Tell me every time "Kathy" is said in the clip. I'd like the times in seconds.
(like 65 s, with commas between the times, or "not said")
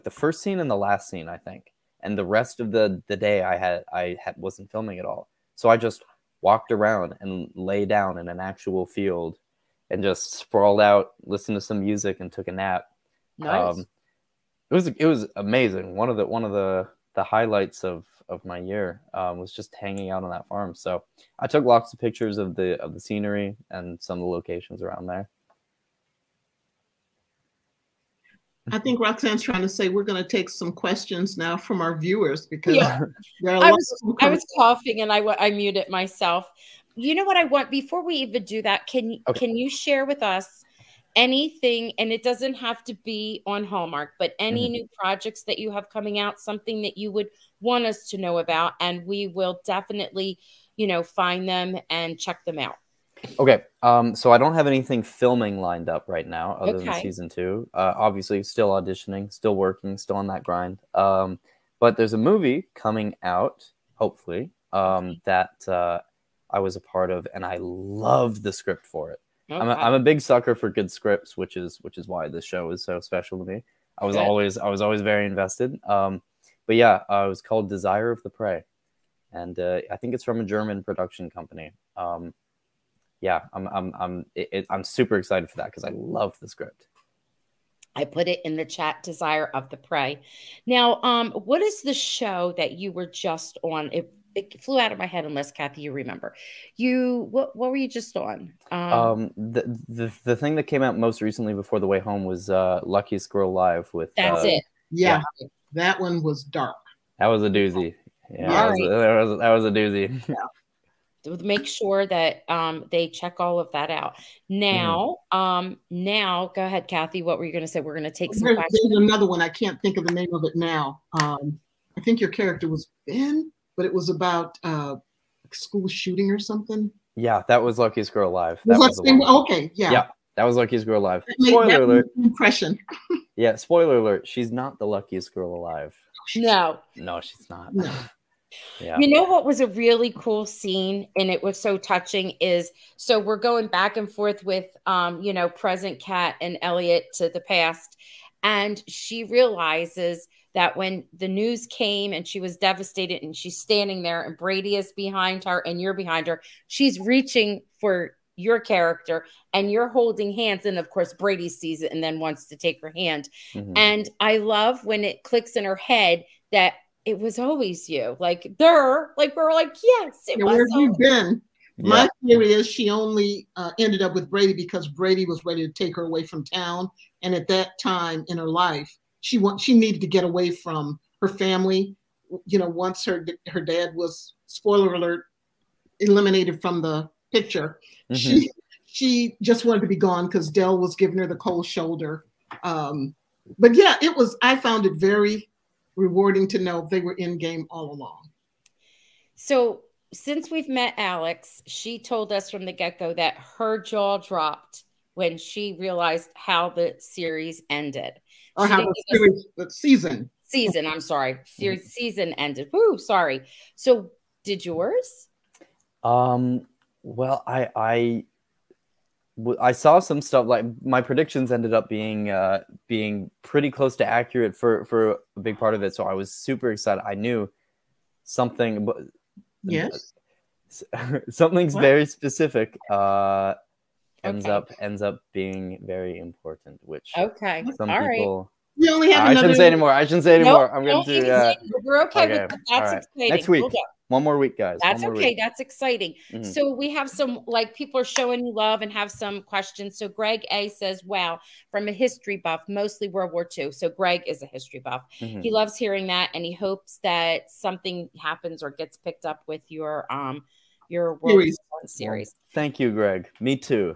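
95 s, 116 s.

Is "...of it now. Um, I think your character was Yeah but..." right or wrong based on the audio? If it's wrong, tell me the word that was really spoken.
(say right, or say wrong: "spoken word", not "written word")
wrong: "Ben", not "Yeah".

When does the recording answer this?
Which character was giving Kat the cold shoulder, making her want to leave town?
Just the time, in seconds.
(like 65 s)
190 s.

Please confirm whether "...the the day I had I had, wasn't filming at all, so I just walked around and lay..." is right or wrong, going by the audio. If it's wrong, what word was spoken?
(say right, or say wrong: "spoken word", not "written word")
right.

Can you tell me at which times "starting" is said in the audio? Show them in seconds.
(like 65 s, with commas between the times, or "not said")
not said.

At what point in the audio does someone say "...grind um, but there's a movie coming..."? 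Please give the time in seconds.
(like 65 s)
60 s.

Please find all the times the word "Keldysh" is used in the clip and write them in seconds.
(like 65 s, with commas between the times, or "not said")
not said.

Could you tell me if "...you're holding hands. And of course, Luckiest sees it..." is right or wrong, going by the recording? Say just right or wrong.
wrong.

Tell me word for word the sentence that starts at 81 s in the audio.
Um, yeah, I'm I'm I'm it, it, I'm super excited for that because I love the script.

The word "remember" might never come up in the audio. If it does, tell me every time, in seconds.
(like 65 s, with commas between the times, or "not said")
95 s.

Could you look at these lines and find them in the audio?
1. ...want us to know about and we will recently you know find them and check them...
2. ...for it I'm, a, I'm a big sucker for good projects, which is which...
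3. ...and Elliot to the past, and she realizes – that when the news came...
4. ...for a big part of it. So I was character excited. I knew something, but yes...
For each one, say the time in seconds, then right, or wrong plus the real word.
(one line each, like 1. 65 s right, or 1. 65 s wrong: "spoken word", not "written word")
1. 47 s wrong: "definitely", not "recently"
2. 68 s wrong: "scripts", not "projects"
3. 146 s right
4. 224 s wrong: "super", not "character".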